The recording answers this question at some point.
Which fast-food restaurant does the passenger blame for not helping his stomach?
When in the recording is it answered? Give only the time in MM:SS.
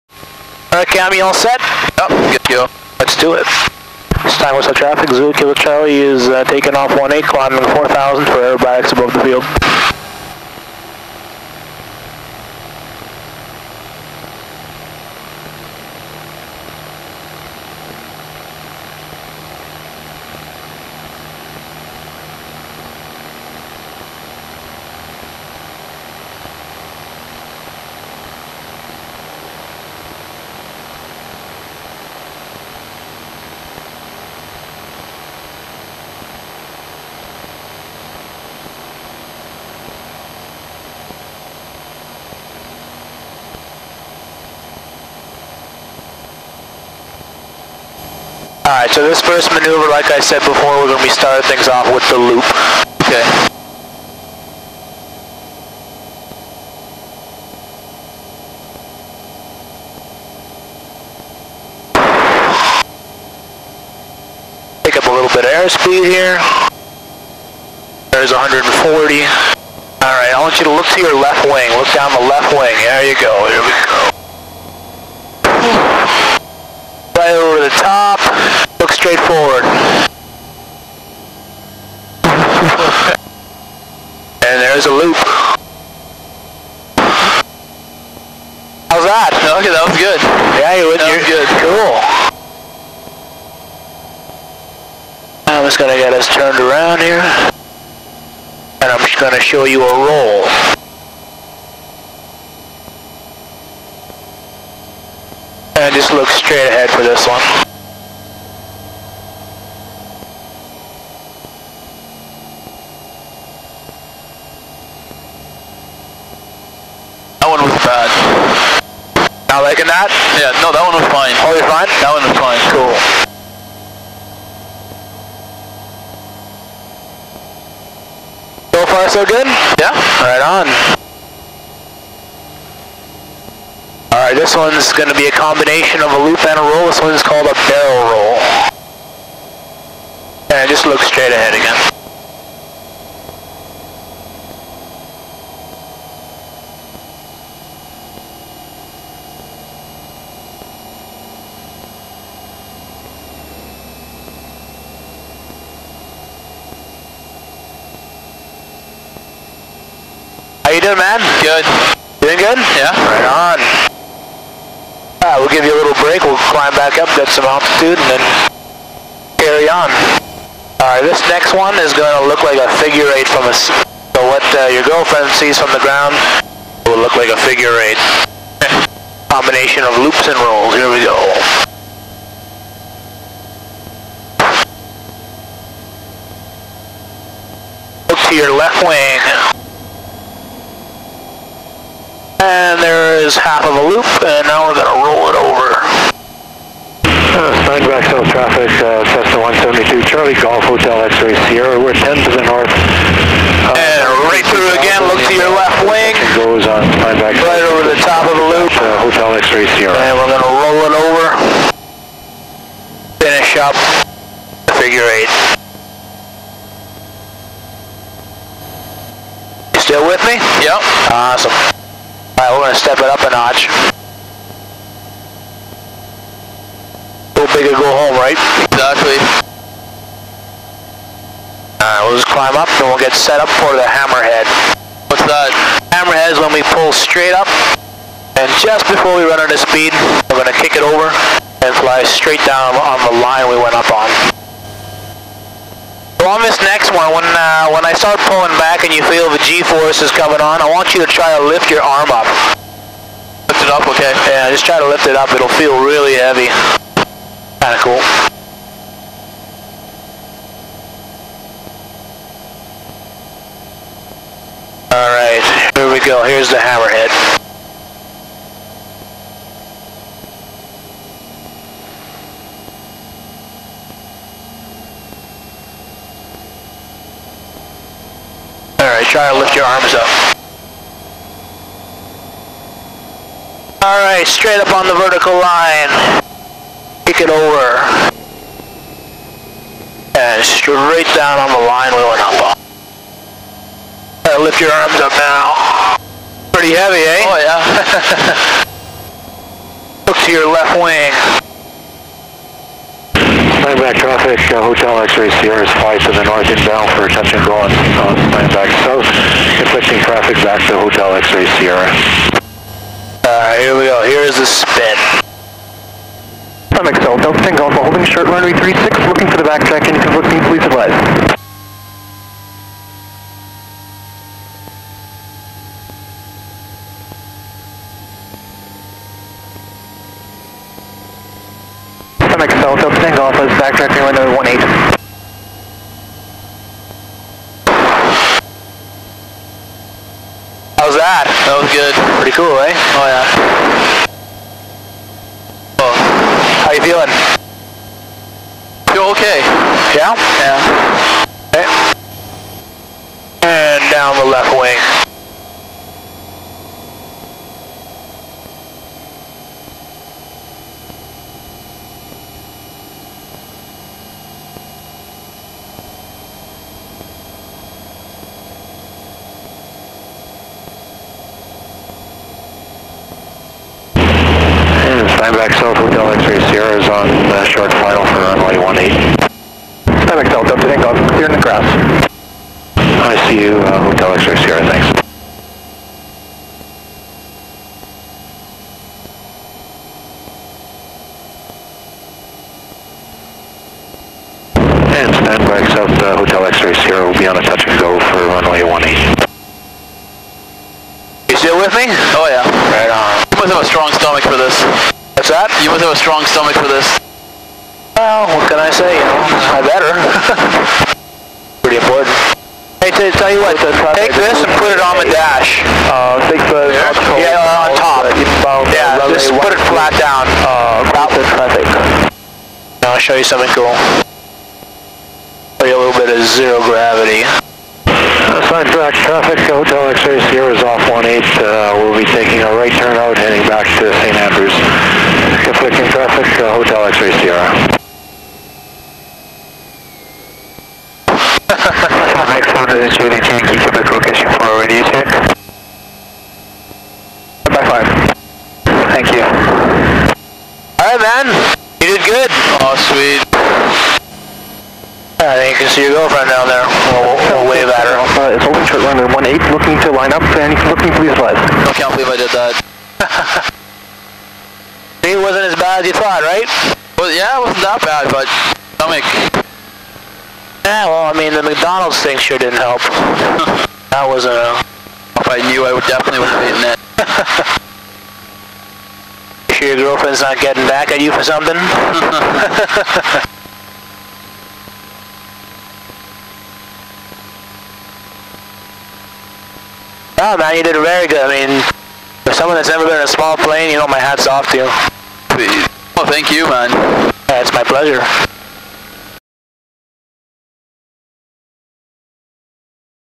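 07:51.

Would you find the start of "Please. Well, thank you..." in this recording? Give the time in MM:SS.
08:15.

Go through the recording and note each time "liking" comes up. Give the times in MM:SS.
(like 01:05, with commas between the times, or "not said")
01:59.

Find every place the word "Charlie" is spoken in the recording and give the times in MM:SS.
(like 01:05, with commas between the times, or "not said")
00:05, 03:20.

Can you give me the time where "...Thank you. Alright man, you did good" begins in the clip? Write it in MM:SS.
07:28.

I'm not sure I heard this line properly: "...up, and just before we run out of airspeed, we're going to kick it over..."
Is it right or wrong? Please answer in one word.
wrong.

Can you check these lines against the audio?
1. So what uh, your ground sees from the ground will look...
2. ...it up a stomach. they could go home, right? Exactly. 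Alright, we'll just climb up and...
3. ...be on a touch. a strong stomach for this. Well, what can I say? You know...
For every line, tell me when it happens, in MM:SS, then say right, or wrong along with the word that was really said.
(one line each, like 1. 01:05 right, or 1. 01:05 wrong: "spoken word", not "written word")
1. 02:53 wrong: "girlfriend", not "ground"
2. 03:42 wrong: "notch", not "stomach"
3. 06:37 right.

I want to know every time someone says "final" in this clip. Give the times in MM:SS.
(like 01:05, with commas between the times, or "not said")
06:17.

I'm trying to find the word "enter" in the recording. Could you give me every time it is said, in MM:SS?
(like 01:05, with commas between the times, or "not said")
not said.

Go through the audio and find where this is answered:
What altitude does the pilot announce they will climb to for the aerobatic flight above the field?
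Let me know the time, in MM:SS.
00:07.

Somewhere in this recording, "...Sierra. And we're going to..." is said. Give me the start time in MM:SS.
03:29.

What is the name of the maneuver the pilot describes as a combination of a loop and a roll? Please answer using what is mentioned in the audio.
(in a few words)
Barrel roll.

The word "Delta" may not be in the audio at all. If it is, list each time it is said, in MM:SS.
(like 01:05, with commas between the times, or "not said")
05:17, 05:32, 06:20.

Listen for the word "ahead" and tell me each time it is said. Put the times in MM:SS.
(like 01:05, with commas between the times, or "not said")
01:46, 02:21.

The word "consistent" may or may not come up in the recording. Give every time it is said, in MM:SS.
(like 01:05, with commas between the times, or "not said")
not said.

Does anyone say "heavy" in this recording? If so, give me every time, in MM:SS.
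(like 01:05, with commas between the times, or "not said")
04:16, 04:56.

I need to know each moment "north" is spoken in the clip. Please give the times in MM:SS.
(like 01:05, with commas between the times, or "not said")
03:22, 05:06.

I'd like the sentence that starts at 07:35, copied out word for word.
you can see your girlfriend down there.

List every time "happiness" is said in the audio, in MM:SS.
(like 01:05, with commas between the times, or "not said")
not said.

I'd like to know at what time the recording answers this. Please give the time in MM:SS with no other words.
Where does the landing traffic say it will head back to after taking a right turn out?
07:14.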